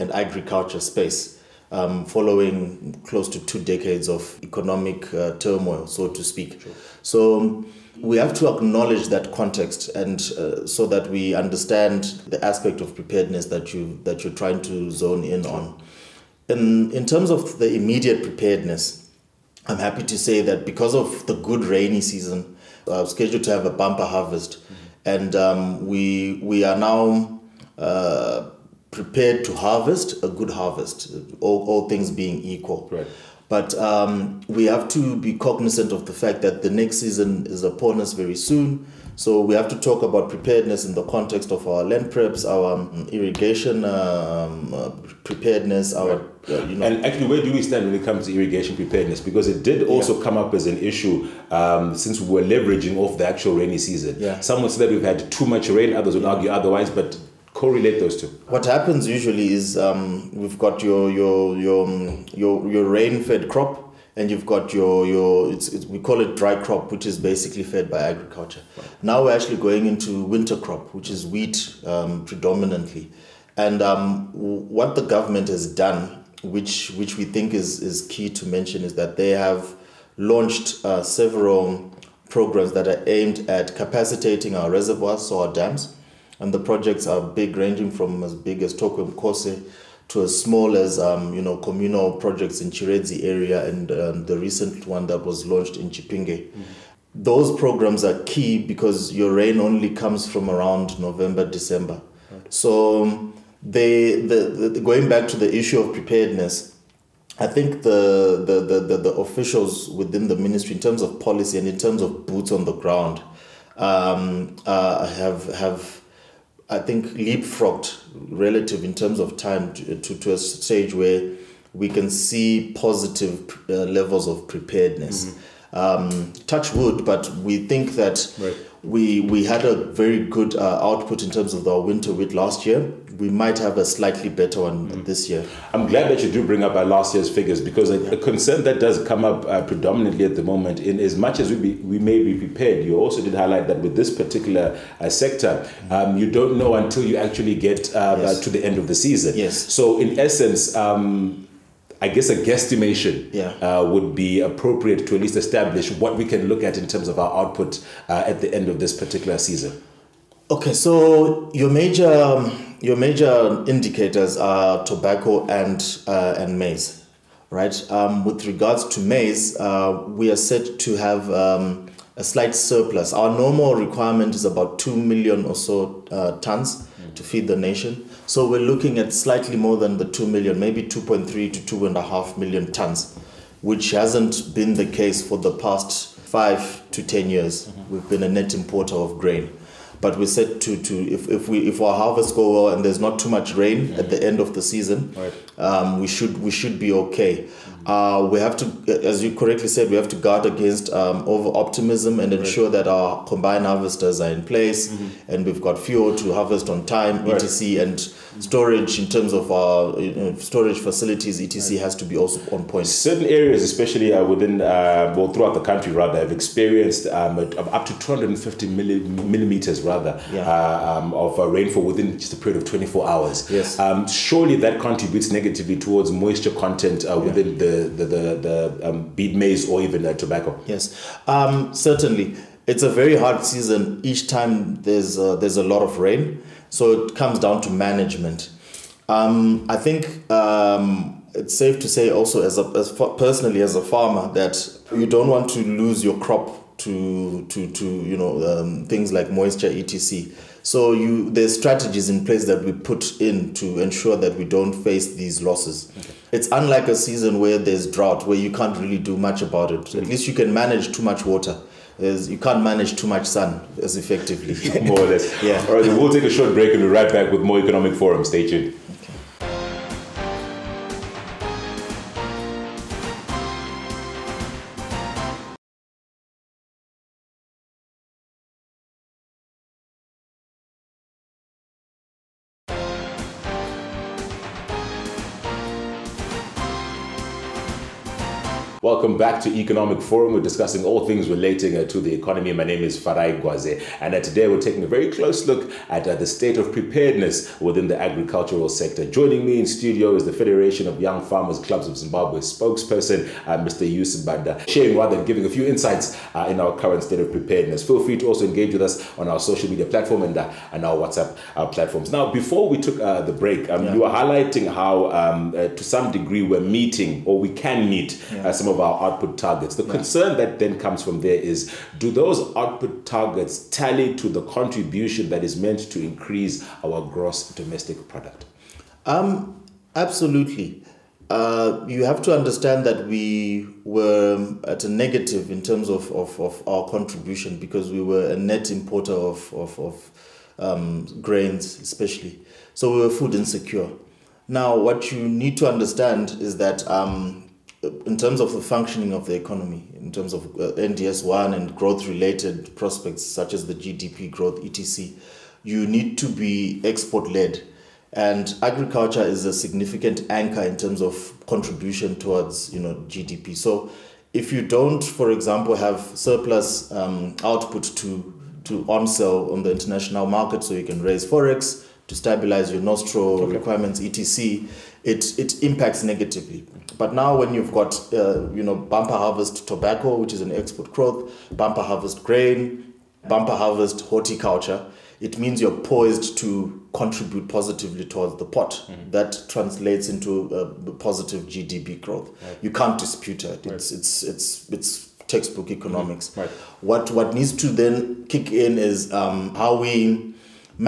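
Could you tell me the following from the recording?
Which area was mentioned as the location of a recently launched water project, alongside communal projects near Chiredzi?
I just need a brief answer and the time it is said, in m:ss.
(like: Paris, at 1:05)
Chipinge, at 1:35.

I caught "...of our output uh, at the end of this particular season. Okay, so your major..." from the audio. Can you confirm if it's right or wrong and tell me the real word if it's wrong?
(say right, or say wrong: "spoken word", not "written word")
right.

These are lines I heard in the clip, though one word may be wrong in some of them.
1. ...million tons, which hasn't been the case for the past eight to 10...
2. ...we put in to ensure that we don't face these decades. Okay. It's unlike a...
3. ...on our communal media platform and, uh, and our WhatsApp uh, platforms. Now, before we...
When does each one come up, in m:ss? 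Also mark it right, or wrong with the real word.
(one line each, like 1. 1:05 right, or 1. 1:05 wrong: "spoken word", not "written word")
1. 3:02 wrong: "five", not "eight"
2. 4:12 wrong: "losses", not "decades"
3. 5:09 wrong: "social", not "communal".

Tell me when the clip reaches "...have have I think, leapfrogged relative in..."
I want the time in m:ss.
1:55.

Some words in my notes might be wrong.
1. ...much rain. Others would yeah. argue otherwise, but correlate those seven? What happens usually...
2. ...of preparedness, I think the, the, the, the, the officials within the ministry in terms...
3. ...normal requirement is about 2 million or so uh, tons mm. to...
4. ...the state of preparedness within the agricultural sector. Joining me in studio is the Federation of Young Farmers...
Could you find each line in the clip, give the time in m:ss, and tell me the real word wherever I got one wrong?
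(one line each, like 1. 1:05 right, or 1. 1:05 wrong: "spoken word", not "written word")
1. 0:55 wrong: "two", not "seven"
2. 1:45 right
3. 2:53 right
4. 4:56 right.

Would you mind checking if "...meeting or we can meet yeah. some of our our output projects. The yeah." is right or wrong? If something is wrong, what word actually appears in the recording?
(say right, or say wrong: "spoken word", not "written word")
wrong: "targets", not "projects".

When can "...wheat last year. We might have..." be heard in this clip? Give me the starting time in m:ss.
2:12.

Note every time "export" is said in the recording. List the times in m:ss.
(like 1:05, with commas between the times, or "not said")
5:56, 6:20.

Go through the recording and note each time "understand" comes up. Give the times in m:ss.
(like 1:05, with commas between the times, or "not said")
0:11, 5:32, 5:45.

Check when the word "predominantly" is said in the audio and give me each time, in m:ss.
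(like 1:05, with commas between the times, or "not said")
1:12, 2:19.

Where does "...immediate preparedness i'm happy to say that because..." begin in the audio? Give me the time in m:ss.
0:17.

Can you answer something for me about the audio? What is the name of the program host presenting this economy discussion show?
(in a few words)
Farai Gwaze.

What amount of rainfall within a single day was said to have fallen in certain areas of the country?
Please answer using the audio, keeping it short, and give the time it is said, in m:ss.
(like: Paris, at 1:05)
250 millimeters, at 3:37.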